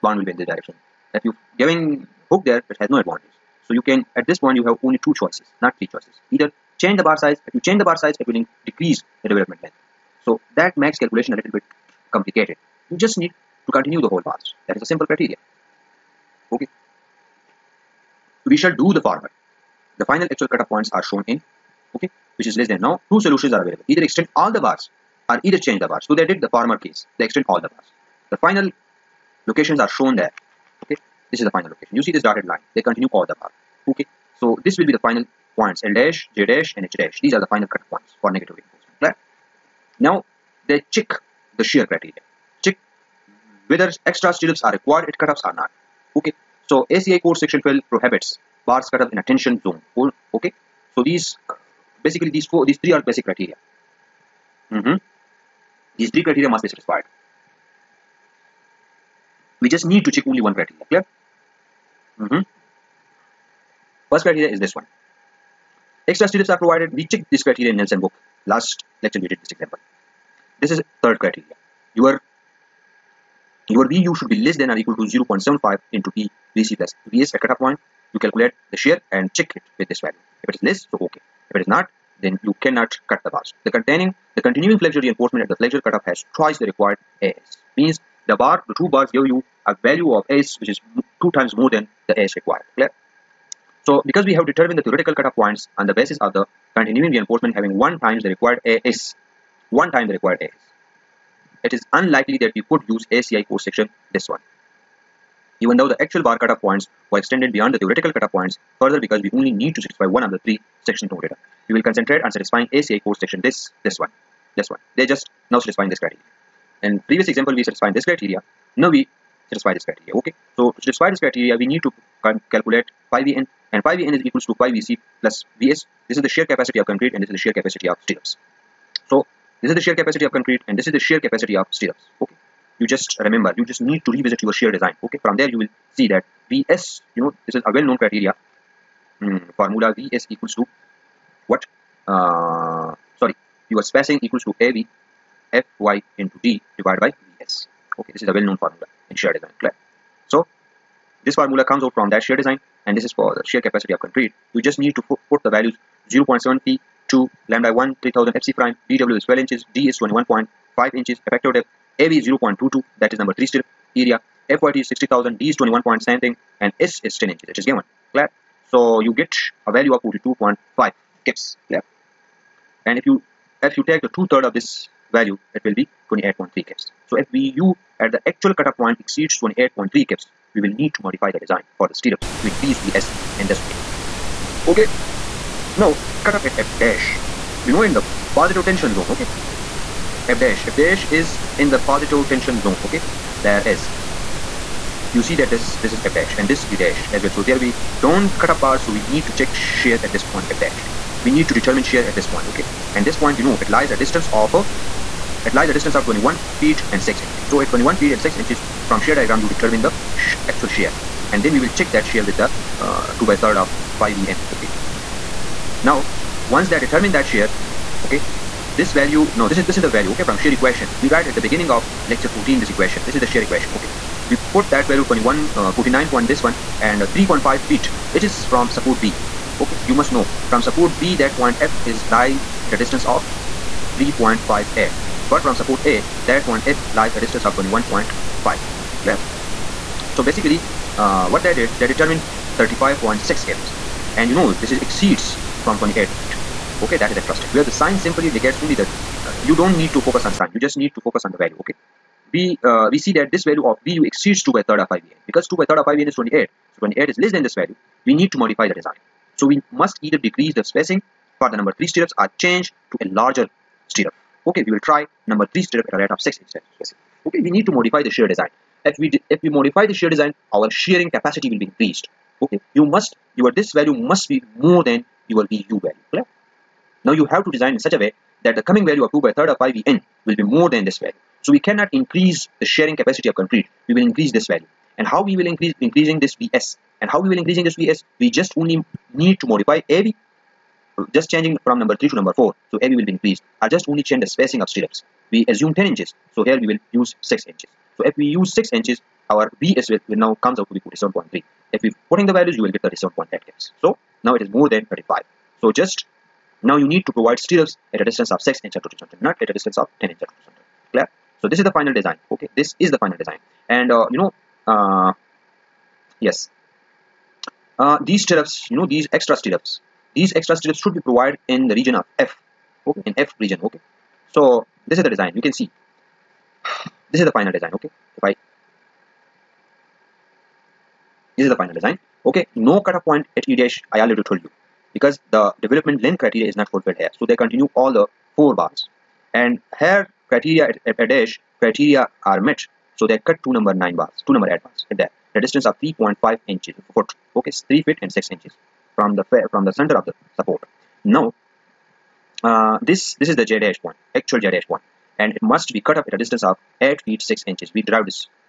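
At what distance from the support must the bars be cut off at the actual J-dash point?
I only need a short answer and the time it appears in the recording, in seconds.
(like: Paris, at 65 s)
8 feet 6 inches, at 356 s.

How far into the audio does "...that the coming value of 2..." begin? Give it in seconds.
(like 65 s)
278 s.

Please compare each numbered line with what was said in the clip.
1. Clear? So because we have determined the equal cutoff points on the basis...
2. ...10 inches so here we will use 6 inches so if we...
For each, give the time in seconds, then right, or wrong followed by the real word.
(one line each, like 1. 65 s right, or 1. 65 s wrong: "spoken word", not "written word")
1. 92 s wrong: "theoretical", not "equal"
2. 295 s right.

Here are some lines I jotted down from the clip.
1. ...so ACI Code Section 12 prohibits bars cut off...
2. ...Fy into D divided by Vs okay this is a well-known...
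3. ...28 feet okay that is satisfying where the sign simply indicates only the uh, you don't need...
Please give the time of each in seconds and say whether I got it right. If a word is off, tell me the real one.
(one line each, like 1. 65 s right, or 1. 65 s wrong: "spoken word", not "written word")
1. 46 s right
2. 145 s right
3. 245 s wrong: "interesting", not "satisfying".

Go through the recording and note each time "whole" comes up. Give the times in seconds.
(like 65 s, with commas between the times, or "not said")
14 s.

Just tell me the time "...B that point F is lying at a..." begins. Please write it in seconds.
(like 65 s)
231 s.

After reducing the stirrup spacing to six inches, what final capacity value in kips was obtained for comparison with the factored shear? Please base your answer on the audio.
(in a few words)
37.8 kips.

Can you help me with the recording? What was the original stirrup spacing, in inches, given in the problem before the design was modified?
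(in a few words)
10 inches.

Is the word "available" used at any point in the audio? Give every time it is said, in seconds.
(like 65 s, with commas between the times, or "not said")
23 s.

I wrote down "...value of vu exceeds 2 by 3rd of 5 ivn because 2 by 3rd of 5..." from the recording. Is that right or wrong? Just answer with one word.
right.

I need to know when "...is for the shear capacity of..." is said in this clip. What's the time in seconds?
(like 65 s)
153 s.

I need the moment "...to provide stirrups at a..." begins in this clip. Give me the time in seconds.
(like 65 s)
307 s.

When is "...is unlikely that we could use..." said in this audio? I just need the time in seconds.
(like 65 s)
101 s.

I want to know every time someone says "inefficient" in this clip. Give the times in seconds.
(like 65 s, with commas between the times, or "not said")
not said.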